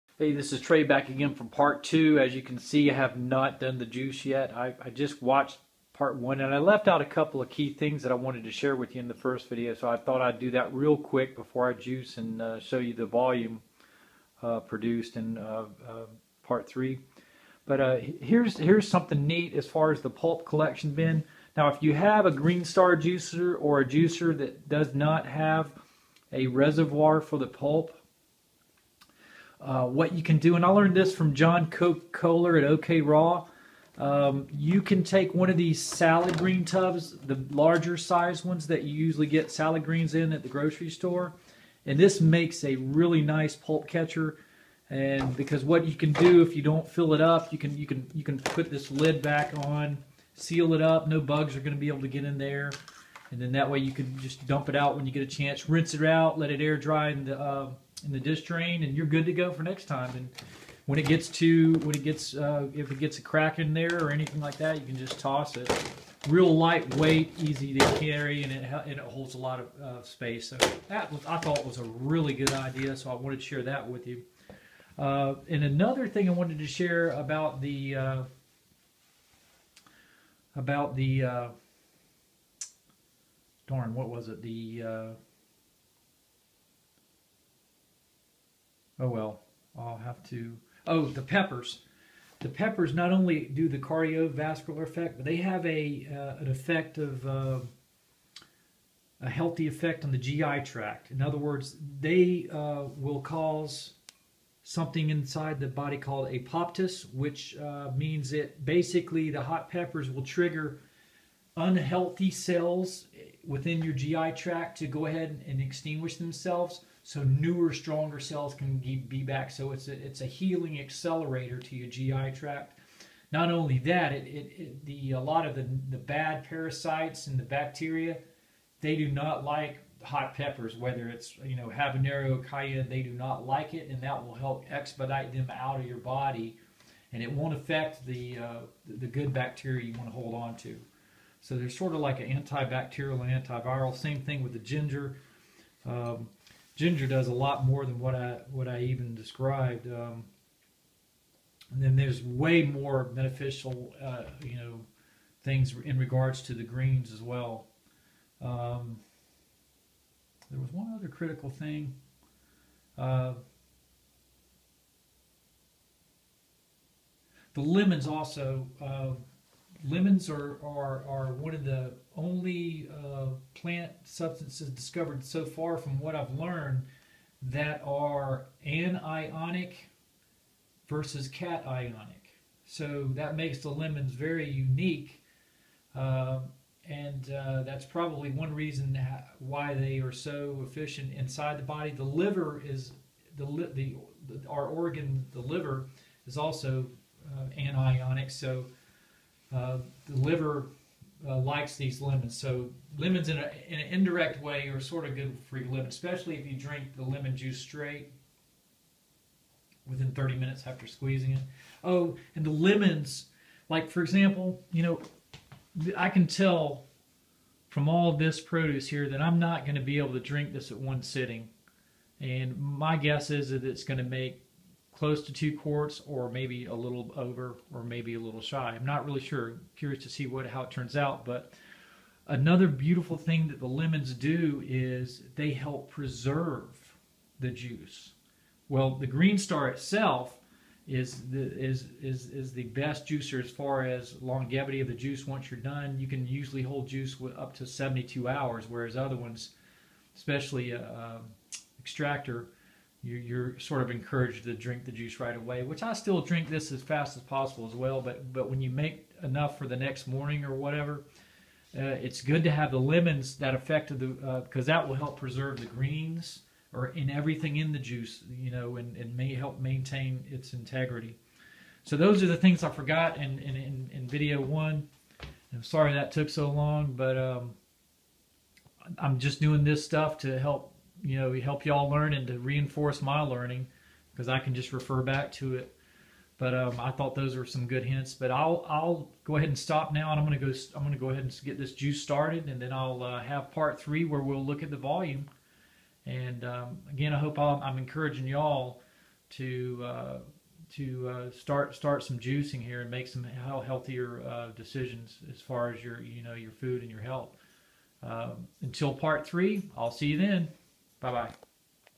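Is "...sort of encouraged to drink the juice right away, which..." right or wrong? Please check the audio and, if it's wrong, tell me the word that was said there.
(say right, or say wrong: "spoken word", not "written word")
right.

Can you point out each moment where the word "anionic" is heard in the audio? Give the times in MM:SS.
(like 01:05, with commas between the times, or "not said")
02:58, 03:17.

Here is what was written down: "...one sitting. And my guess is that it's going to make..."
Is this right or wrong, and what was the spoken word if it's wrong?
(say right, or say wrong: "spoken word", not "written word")
right.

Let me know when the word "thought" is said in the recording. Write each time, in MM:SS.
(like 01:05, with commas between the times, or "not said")
00:09, 01:11, 04:46.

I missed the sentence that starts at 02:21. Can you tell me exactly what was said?
So they're sort of like an antibacterial and antiviral.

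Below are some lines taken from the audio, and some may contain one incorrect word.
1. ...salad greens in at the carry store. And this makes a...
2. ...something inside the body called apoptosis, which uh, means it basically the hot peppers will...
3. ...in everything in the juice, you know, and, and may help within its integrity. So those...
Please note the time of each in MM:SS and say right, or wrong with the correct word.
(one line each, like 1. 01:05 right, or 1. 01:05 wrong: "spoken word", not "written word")
1. 00:39 wrong: "grocery", not "carry"
2. 01:44 right
3. 04:26 wrong: "maintain", not "within".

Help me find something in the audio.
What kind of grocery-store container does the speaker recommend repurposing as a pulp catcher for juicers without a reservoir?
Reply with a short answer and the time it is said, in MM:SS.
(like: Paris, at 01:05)
salad green tubs, at 00:35.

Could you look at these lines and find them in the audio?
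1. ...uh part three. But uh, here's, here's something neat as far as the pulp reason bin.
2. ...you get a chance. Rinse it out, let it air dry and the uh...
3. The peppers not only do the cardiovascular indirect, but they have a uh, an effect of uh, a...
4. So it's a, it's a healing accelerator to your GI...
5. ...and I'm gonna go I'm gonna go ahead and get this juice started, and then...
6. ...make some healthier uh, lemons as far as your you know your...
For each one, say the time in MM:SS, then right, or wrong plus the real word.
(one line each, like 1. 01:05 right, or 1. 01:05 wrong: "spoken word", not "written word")
1. 00:15 wrong: "collection", not "reason"
2. 00:55 right
3. 01:32 wrong: "effect", not "indirect"
4. 01:59 right
5. 04:50 right
6. 05:02 wrong: "decisions", not "lemons".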